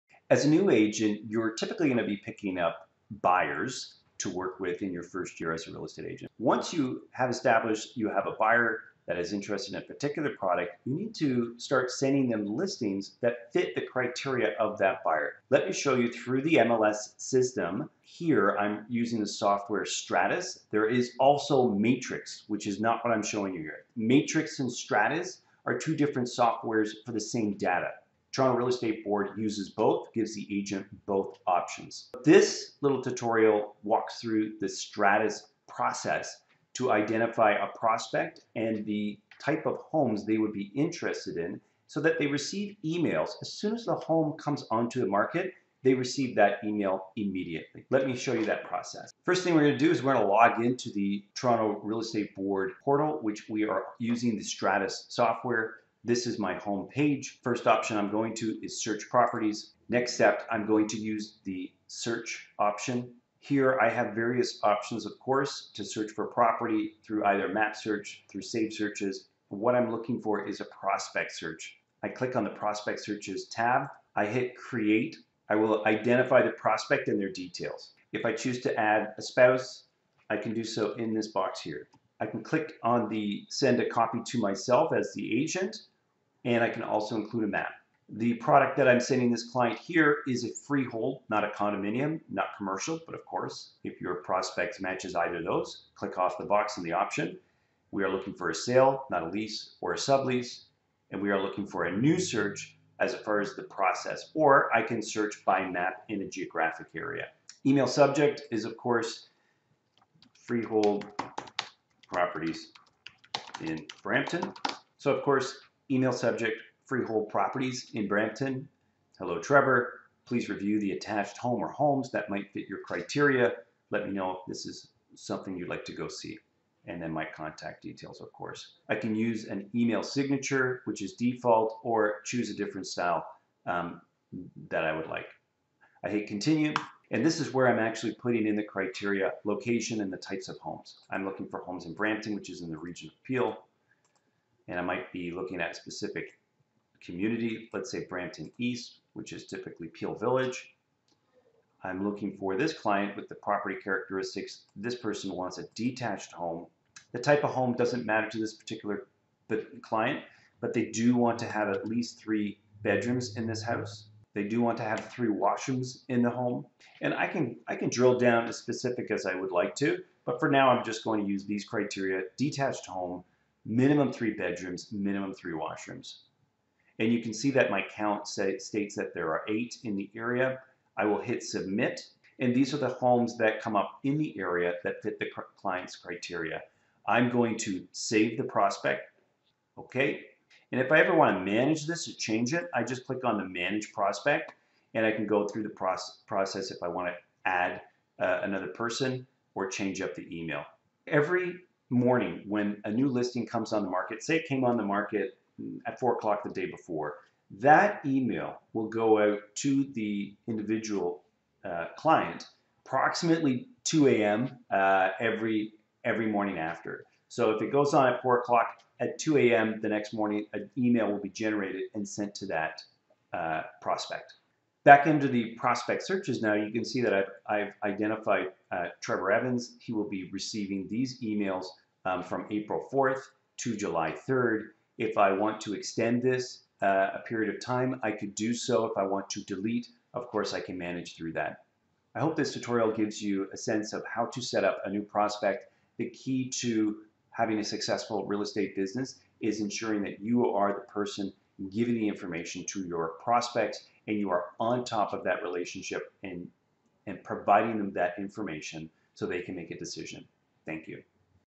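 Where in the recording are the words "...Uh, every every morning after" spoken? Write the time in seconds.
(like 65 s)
214 s.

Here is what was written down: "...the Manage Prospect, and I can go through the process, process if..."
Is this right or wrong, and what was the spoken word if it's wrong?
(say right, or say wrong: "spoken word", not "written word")
right.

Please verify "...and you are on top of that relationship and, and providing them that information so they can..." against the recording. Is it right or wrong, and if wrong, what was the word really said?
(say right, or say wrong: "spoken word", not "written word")
right.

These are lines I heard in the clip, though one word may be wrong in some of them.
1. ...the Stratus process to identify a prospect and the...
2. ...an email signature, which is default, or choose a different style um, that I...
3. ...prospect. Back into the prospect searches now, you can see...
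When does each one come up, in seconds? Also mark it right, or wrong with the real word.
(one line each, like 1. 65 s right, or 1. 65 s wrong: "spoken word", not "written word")
1. 34 s right
2. 129 s right
3. 223 s right.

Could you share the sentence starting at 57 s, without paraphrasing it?
First option I'm going to is search properties.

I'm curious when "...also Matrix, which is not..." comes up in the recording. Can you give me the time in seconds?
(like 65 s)
21 s.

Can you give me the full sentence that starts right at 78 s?
If I choose to add a spouse, I can do so in this box here.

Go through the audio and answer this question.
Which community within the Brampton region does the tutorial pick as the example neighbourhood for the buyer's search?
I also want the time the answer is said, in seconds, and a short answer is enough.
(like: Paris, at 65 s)
Brampton East, at 148 s.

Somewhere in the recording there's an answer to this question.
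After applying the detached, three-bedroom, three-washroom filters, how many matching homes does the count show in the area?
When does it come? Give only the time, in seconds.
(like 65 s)
179 s.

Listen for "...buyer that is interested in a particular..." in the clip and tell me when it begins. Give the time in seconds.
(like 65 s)
8 s.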